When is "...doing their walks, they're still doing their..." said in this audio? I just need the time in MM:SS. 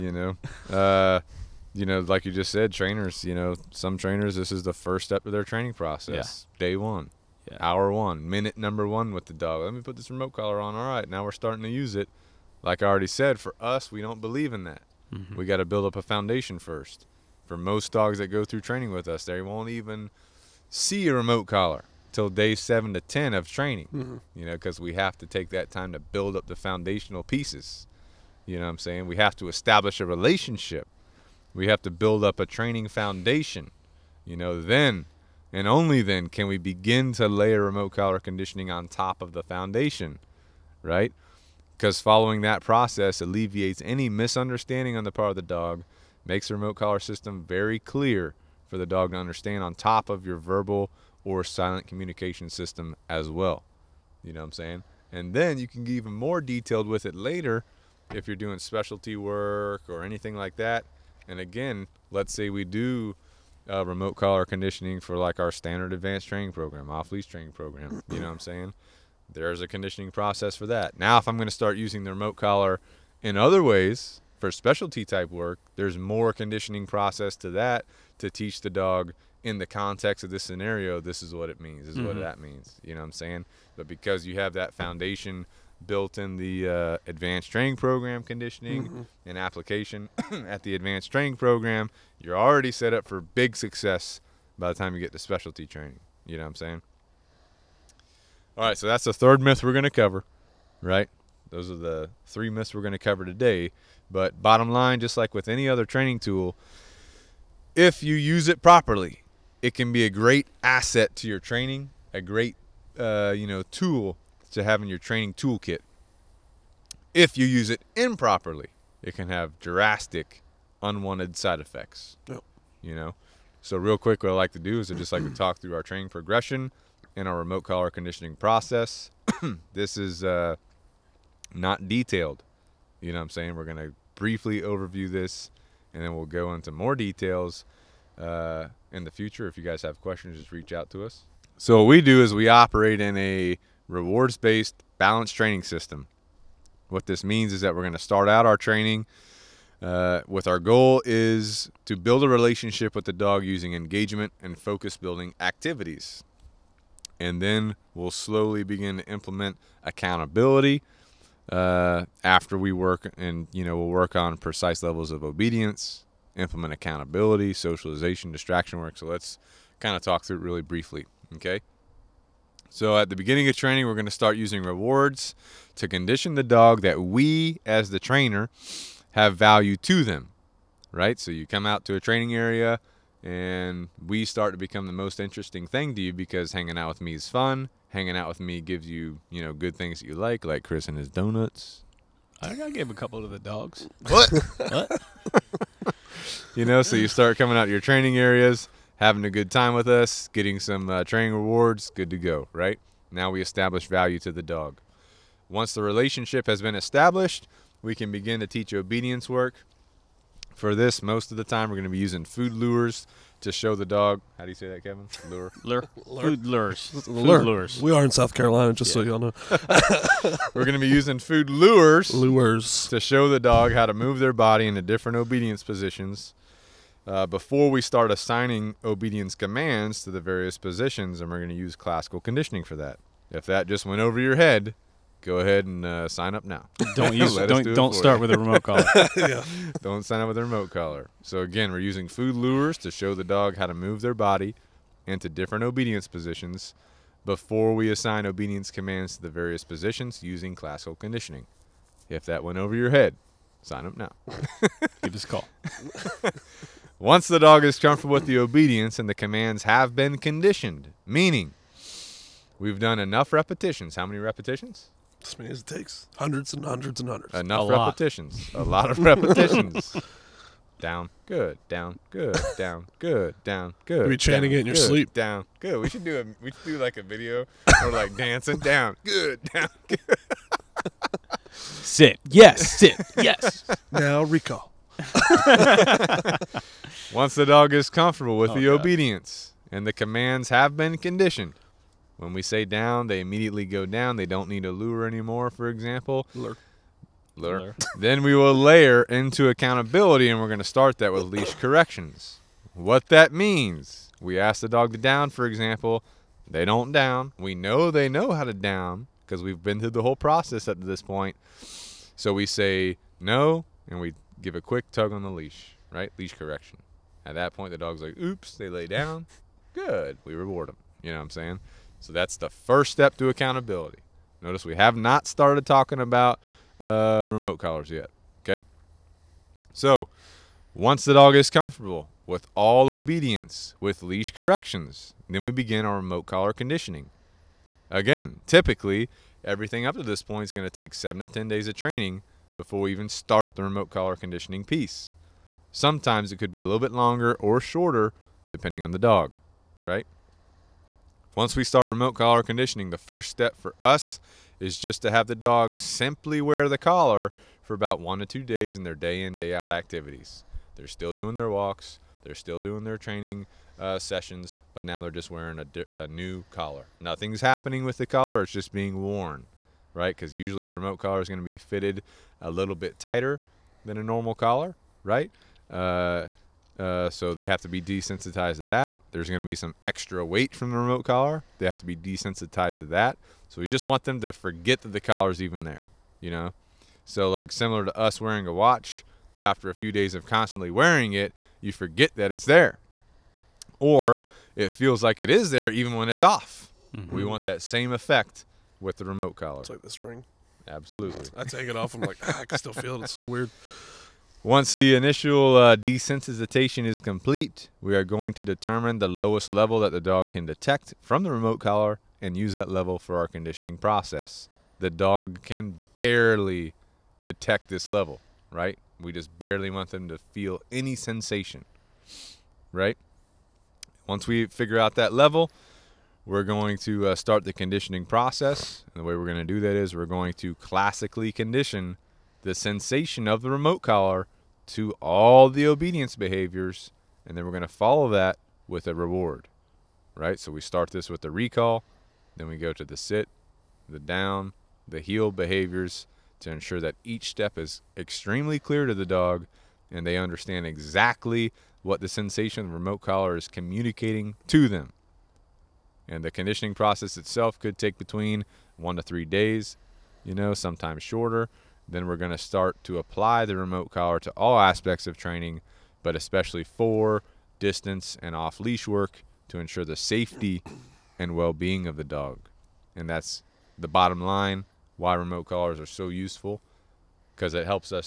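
06:01.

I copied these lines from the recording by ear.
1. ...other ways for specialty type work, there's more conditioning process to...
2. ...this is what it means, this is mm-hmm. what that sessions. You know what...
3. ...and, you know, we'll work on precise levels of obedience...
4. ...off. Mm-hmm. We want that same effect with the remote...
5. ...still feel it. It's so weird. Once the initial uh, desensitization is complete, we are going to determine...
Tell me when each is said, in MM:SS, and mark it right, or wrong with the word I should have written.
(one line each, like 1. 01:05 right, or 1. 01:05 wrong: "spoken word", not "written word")
1. 01:13 right
2. 01:21 wrong: "means", not "sessions"
3. 02:43 right
4. 06:36 right
5. 06:42 right.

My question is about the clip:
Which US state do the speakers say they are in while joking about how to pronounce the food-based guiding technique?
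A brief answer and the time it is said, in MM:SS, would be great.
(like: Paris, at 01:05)
South Carolina, at 03:38.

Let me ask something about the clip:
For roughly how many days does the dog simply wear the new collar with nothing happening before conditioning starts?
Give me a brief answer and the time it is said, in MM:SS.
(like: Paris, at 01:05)
1 to 2 days, at 05:58.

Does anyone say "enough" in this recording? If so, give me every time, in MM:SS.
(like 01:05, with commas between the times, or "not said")
04:22, 04:27.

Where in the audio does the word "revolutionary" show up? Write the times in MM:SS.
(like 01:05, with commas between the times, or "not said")
not said.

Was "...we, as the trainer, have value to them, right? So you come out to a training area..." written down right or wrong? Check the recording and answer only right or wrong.
right.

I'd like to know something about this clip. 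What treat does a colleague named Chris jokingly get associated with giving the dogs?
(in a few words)
Donuts.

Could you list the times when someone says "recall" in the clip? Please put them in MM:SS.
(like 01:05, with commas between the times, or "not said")
04:44, 07:21.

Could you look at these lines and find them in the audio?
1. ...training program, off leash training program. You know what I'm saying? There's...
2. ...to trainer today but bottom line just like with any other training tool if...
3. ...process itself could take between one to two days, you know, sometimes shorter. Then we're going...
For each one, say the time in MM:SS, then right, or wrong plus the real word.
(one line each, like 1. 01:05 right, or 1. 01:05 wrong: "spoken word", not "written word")
1. 01:06 right
2. 01:42 wrong: "cover", not "trainer"
3. 07:36 wrong: "three", not "two".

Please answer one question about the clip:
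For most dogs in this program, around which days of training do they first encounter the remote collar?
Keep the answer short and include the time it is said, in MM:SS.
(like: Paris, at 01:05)
Day 7 to 10, at 00:22.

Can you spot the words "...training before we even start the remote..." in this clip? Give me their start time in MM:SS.
05:41.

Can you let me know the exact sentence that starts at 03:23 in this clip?
Now we establish value to the dog.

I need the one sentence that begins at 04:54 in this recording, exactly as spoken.
They don't need a lure anymore, for example.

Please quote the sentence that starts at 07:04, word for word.
Once we figure out that level, we're going to uh, start the conditioning process.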